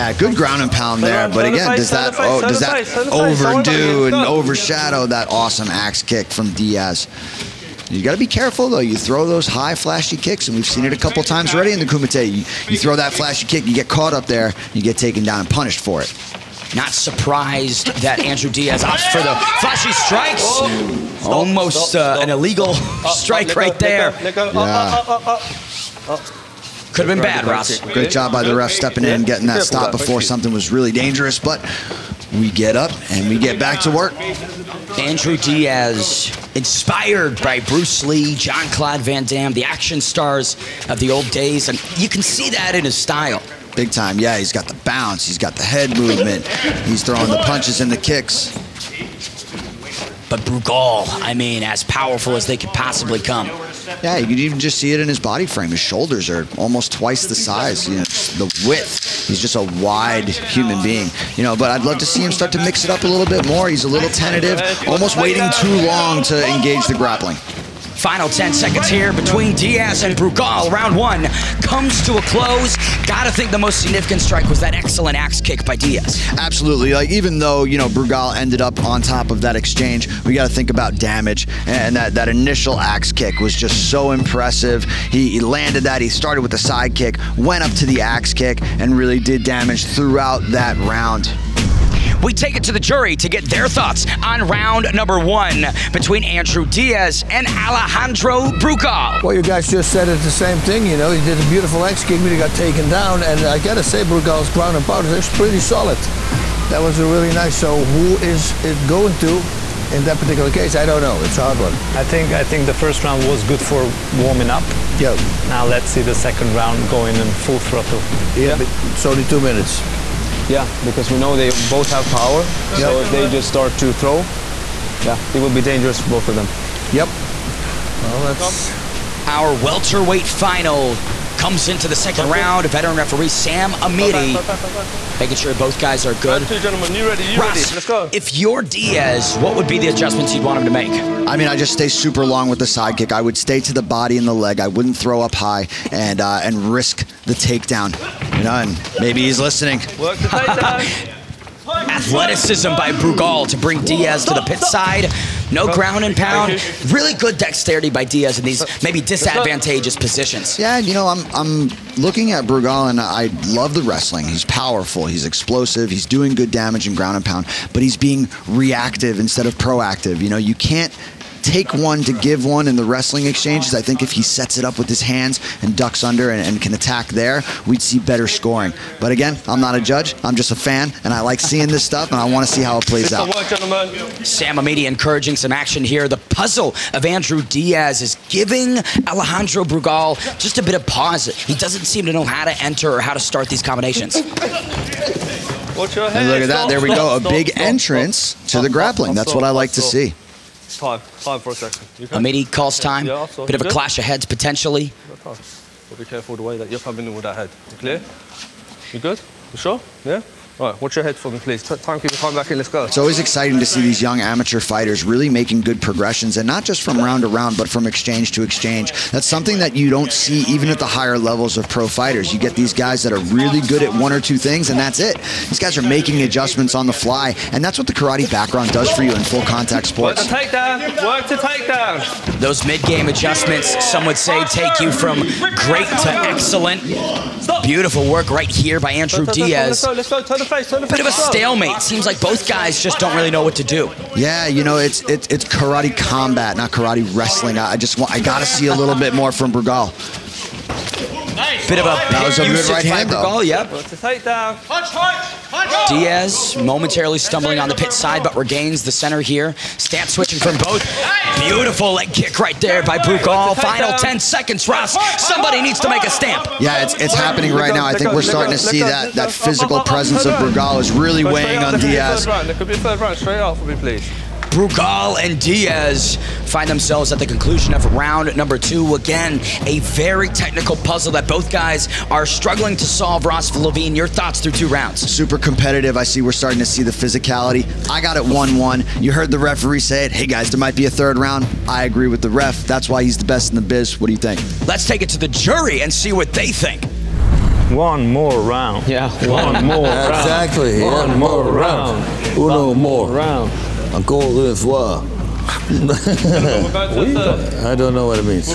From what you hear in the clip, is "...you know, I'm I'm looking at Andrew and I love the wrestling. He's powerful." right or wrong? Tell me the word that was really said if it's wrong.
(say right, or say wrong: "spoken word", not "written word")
wrong: "Brugal", not "Andrew".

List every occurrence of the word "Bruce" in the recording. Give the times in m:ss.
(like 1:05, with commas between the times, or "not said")
0:37.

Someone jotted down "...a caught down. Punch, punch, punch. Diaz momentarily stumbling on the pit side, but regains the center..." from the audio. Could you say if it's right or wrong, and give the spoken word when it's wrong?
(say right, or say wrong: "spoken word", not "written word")
wrong: "tight", not "caught".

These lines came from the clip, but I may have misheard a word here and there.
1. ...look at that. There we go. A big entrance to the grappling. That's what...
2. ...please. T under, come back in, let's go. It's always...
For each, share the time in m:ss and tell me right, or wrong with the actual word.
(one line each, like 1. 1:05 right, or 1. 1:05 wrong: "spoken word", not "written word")
1. 3:16 right
2. 3:31 wrong: "timekeeper", not "under".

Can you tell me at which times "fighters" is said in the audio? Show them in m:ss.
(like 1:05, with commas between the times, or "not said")
3:34, 3:41.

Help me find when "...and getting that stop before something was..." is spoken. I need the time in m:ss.
0:29.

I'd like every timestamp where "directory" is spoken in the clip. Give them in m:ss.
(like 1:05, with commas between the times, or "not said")
not said.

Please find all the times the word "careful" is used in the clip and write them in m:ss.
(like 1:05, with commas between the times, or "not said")
0:08, 3:26.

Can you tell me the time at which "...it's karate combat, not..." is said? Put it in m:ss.
4:05.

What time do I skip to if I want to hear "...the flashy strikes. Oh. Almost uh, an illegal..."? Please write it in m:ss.
0:19.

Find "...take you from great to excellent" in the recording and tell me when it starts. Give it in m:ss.
3:54.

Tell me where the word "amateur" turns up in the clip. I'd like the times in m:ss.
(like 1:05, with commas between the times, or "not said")
3:34.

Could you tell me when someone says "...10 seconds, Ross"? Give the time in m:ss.
4:23.